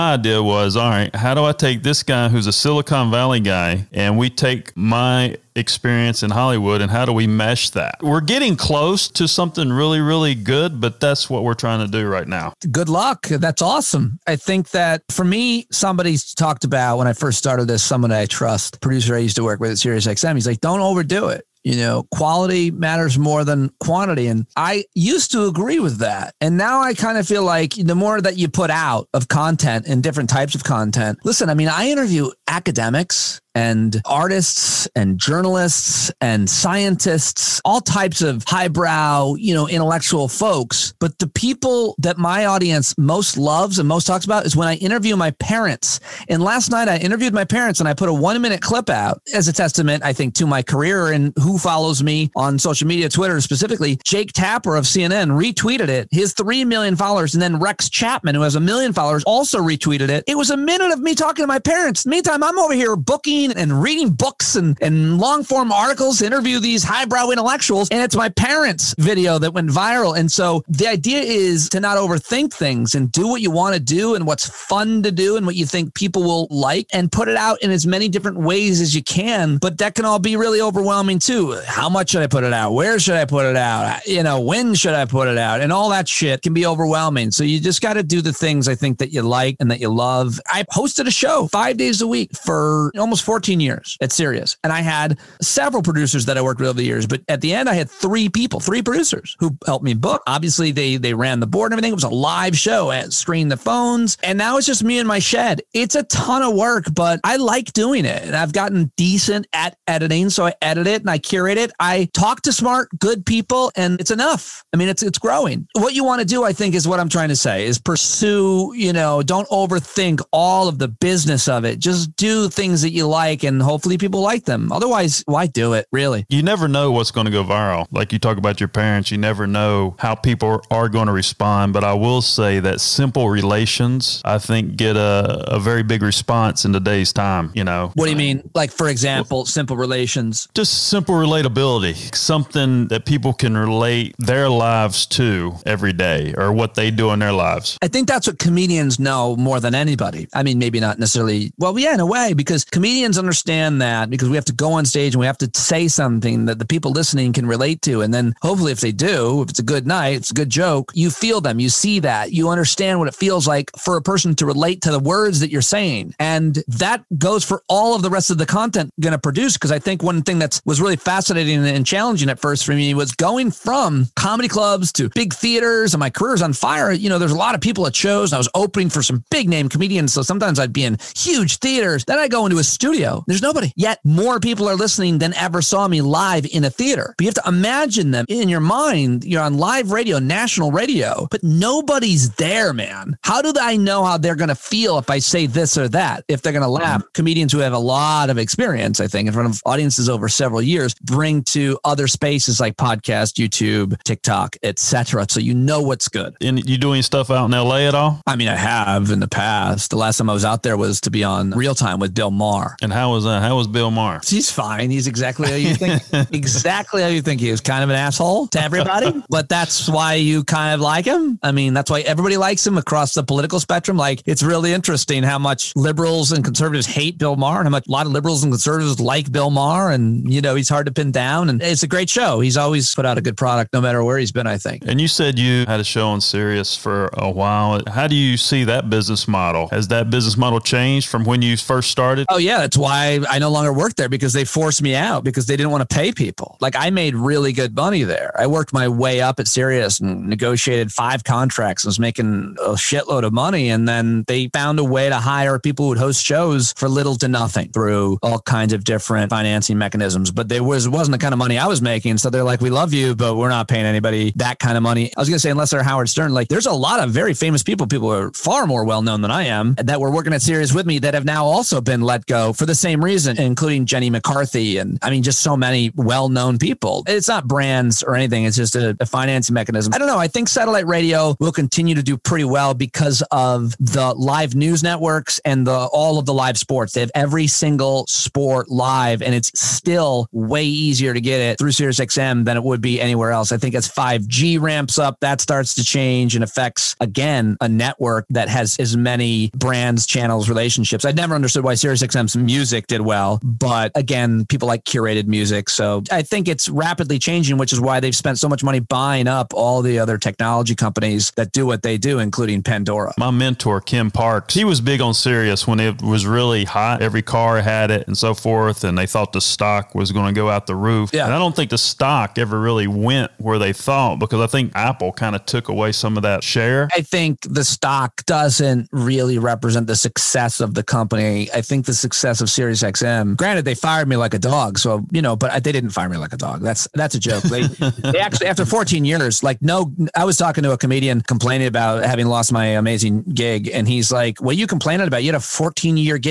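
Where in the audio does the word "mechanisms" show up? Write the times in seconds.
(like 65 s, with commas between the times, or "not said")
259 s, 279 s.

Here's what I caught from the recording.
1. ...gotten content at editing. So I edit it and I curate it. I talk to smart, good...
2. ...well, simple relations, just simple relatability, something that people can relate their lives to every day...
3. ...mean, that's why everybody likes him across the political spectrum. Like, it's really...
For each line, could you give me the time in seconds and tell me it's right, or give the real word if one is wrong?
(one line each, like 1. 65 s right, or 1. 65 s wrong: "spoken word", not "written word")
1. 108 s wrong: "decent", not "content"
2. 139 s right
3. 221 s right.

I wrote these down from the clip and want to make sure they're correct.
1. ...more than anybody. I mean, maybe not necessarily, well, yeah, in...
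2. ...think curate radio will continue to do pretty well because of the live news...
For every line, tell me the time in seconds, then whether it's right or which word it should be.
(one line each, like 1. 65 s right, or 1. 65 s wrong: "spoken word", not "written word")
1. 149 s right
2. 280 s wrong: "satellite", not "curate".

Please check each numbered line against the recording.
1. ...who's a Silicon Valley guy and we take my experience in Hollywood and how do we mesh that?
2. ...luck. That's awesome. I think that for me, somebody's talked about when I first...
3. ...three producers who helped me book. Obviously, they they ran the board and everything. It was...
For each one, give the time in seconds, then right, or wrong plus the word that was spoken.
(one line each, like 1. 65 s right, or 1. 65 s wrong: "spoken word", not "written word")
1. 2 s right
2. 12 s right
3. 98 s right.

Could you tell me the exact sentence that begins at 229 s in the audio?
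And you know, he's hard to pin down.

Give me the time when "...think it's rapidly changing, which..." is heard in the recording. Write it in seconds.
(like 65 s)
306 s.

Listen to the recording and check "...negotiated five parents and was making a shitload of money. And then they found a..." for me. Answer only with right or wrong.
wrong.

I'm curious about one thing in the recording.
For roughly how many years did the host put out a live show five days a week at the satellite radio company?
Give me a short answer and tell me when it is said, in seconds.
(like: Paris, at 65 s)
14, at 92 s.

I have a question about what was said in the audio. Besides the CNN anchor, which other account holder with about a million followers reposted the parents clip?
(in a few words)
Rex Chapman.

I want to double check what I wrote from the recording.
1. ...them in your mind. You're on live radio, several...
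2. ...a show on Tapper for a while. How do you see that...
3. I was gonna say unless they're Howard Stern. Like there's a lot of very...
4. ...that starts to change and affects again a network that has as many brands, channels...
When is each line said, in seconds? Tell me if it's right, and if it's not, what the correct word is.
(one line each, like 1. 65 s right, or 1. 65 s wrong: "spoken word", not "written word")
1. 188 s wrong: "national", not "several"
2. 235 s wrong: "Sirius", not "Tapper"
3. 265 s right
4. 295 s right.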